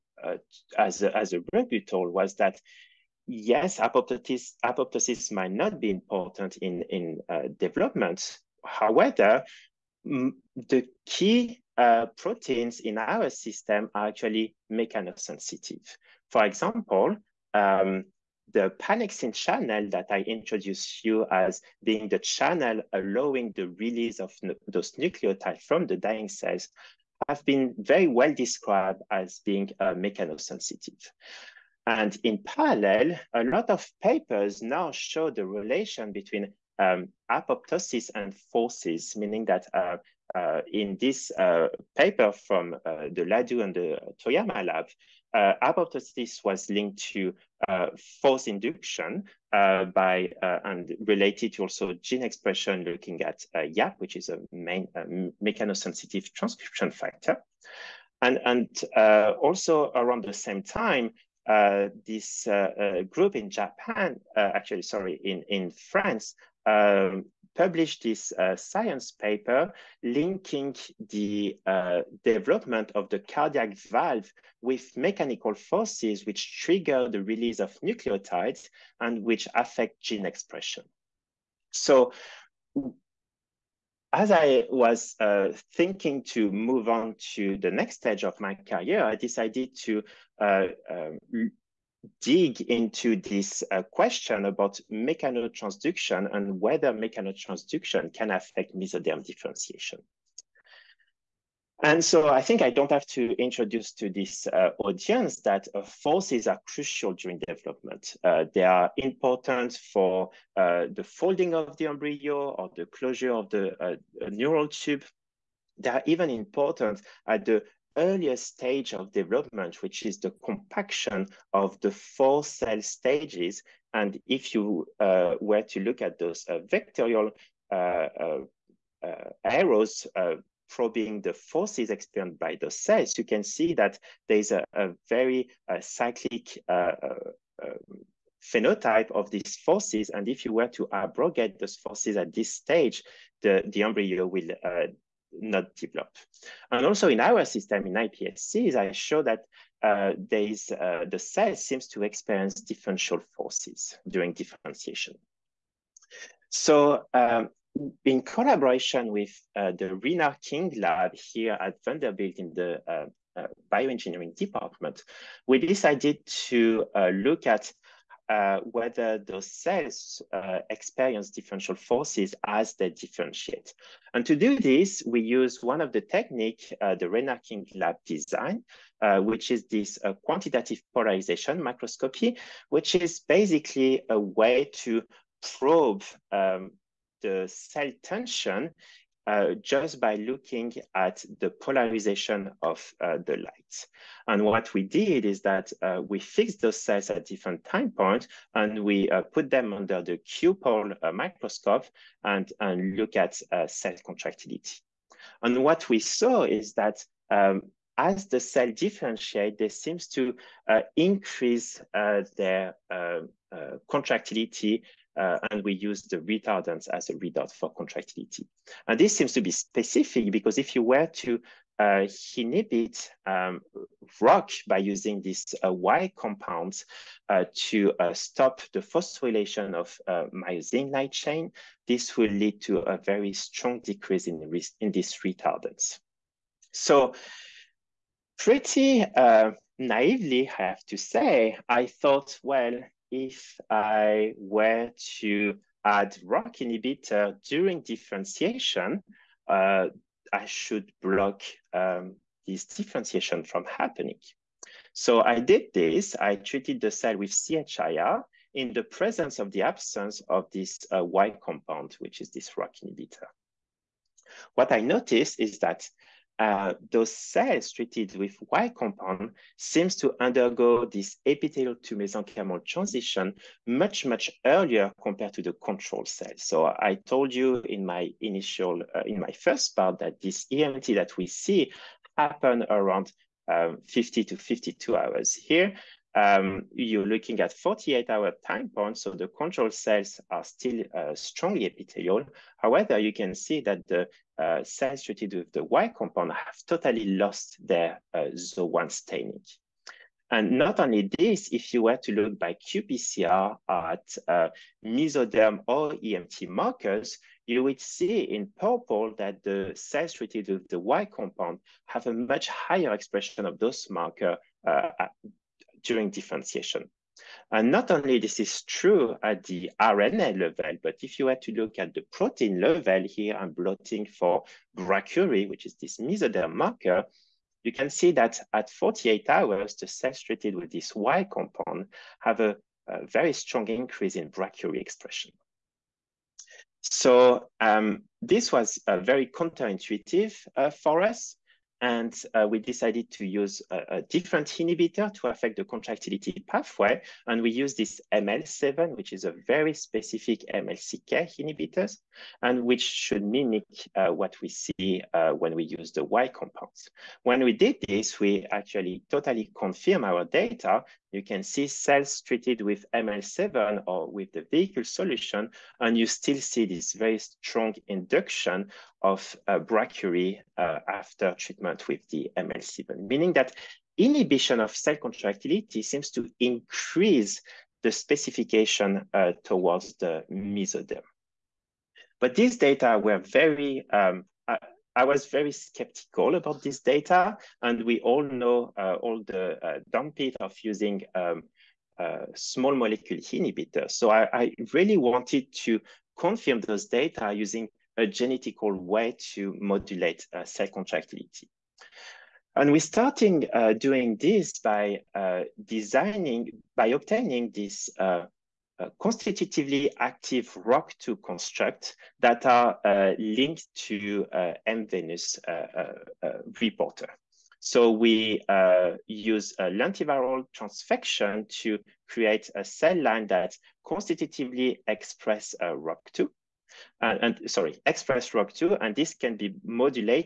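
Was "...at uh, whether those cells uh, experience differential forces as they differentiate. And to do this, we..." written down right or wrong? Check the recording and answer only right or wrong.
right.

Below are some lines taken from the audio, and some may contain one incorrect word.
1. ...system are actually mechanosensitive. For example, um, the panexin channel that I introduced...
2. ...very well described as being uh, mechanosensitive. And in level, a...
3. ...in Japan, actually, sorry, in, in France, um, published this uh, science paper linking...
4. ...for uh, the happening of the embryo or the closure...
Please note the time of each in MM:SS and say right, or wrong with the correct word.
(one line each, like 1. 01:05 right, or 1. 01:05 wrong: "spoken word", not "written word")
1. 00:13 right
2. 00:27 wrong: "parallel", not "level"
3. 01:03 right
4. 01:49 wrong: "folding", not "happening".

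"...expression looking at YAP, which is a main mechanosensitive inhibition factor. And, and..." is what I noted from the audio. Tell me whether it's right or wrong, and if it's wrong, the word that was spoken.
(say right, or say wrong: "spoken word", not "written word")
wrong: "transcription", not "inhibition".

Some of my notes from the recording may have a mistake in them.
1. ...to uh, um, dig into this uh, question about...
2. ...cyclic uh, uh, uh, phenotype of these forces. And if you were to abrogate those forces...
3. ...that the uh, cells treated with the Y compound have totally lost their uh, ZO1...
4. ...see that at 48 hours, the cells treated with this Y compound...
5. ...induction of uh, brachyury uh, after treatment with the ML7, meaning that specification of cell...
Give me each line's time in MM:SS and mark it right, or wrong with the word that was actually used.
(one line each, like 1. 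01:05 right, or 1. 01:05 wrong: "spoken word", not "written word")
1. 01:29 right
2. 02:15 right
3. 04:53 right
4. 05:27 right
5. 06:07 wrong: "inhibition", not "specification".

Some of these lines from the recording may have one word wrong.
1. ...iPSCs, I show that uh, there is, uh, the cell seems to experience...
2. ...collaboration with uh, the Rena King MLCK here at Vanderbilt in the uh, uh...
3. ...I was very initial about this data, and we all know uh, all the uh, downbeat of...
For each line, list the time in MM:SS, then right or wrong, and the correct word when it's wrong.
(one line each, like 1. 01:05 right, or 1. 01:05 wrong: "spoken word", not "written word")
1. 02:27 right
2. 02:38 wrong: "Lab", not "MLCK"
3. 06:24 wrong: "skeptical", not "initial".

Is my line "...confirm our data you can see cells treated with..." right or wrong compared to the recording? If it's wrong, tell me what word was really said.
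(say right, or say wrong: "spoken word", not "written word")
right.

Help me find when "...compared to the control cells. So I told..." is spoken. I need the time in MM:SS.
04:35.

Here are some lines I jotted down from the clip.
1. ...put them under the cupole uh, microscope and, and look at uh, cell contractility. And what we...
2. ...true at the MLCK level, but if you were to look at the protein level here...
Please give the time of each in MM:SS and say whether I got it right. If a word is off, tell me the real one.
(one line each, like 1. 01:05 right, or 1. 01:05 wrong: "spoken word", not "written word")
1. 03:19 right
2. 05:18 wrong: "RNA", not "MLCK".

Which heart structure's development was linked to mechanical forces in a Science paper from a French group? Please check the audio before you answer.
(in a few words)
Cardiac valve.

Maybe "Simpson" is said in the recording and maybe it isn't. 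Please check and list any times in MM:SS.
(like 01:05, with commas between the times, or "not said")
not said.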